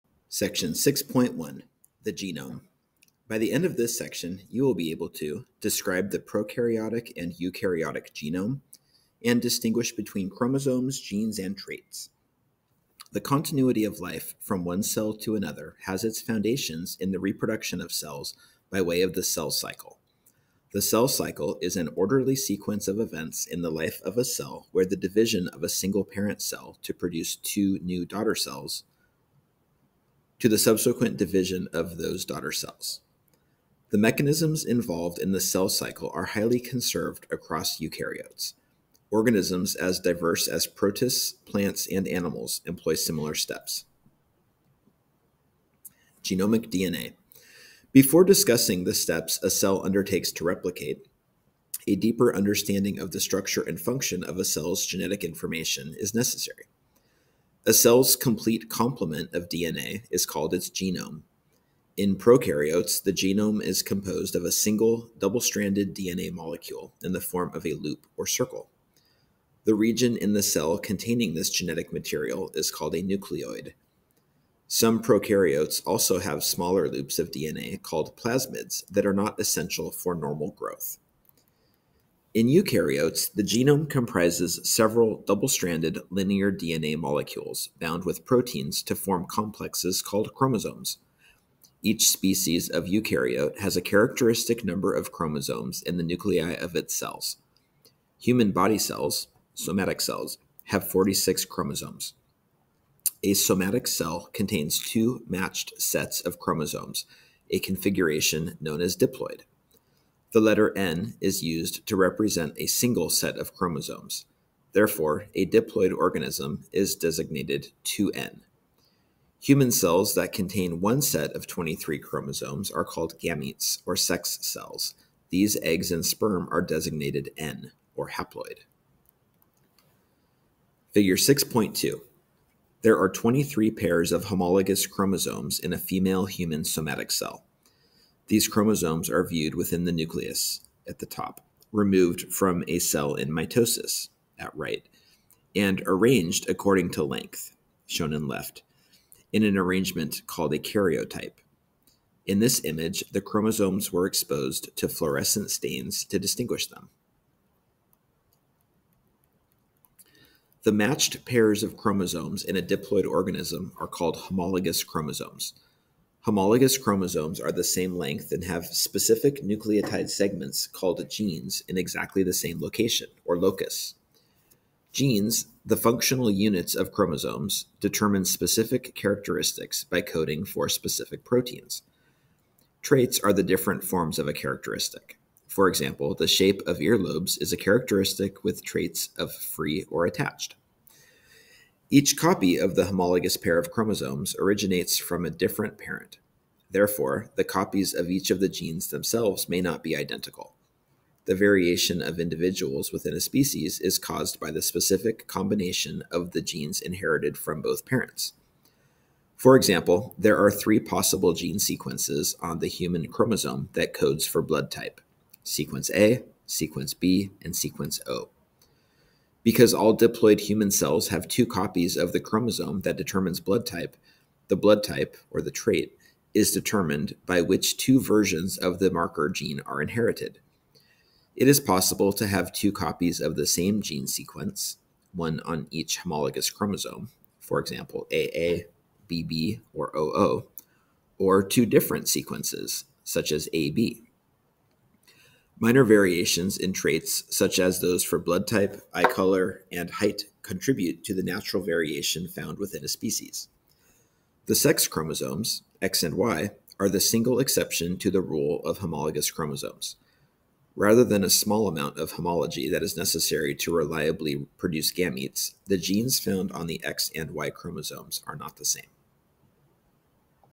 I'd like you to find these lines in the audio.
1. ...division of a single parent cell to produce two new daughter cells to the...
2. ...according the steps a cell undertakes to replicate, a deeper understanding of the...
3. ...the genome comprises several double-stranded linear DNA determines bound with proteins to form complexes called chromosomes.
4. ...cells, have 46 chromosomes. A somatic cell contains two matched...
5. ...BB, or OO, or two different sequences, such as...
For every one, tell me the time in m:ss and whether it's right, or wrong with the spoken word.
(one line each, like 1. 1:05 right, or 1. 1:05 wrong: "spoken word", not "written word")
1. 0:24 right
2. 0:48 wrong: "discussing", not "according"
3. 1:23 wrong: "molecules", not "determines"
4. 1:39 right
5. 3:59 right.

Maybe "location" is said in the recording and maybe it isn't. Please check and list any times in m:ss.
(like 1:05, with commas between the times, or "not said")
2:52.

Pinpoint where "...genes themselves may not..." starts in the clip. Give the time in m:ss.
3:18.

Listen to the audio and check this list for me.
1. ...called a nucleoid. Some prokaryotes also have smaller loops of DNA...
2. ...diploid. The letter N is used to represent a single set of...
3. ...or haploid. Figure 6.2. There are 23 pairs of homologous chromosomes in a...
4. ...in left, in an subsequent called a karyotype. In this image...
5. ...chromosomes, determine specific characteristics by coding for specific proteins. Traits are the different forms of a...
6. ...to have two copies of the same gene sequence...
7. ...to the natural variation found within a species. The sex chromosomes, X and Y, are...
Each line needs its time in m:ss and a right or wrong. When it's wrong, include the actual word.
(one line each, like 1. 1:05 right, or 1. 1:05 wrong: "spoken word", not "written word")
1. 1:12 right
2. 1:48 right
3. 2:07 right
4. 2:28 wrong: "arrangement", not "subsequent"
5. 2:56 right
6. 3:52 right
7. 4:11 right.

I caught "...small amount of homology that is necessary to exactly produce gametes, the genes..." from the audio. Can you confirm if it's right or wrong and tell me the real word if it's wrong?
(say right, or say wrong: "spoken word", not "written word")
wrong: "reliably", not "exactly".